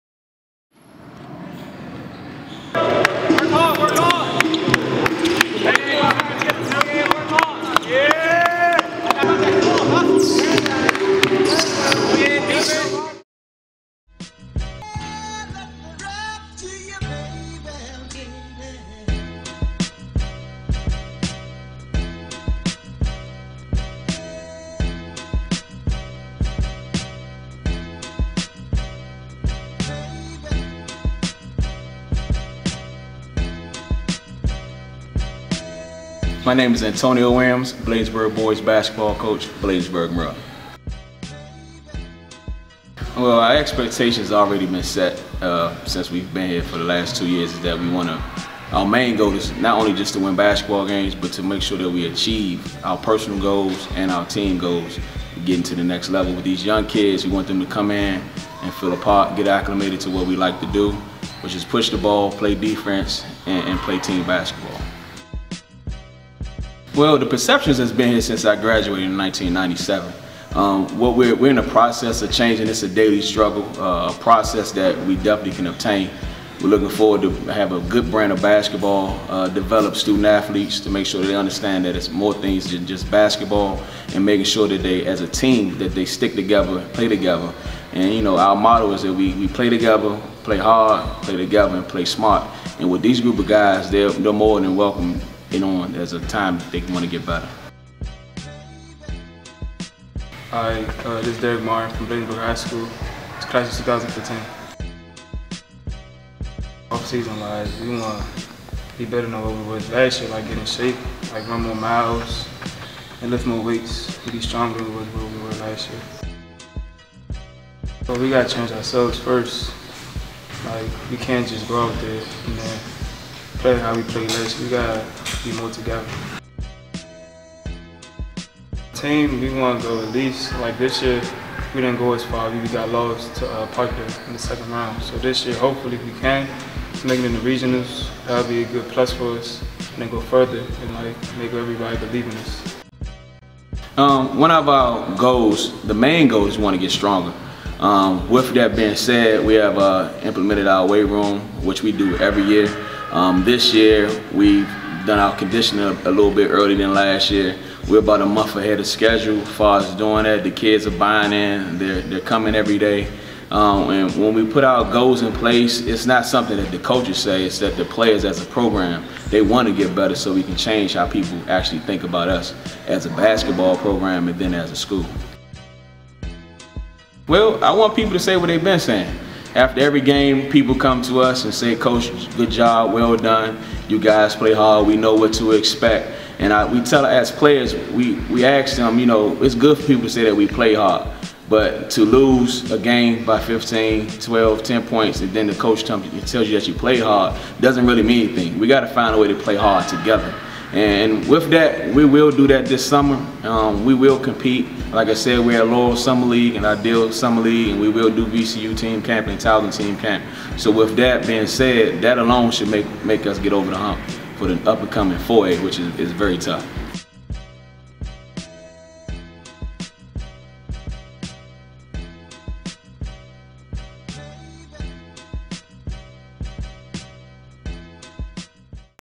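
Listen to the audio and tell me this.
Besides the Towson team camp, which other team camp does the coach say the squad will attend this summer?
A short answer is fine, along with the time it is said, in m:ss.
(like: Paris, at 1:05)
VCU, at 3:28.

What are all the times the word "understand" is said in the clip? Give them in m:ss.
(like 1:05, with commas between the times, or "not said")
1:21.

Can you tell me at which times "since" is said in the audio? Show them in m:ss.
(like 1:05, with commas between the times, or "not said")
0:45, 1:08.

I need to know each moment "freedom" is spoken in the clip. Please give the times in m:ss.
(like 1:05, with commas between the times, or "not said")
not said.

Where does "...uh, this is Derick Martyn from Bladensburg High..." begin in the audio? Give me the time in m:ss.
1:41.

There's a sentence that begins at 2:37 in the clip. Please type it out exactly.
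We're about a month ahead of schedule as far as doing that.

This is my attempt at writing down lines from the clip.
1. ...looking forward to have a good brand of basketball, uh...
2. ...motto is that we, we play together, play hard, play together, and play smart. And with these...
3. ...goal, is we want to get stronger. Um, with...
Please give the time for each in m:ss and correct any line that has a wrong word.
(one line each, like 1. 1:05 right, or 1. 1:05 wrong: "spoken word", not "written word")
1. 1:16 right
2. 1:28 right
3. 2:26 right.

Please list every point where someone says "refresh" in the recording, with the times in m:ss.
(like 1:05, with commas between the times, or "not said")
not said.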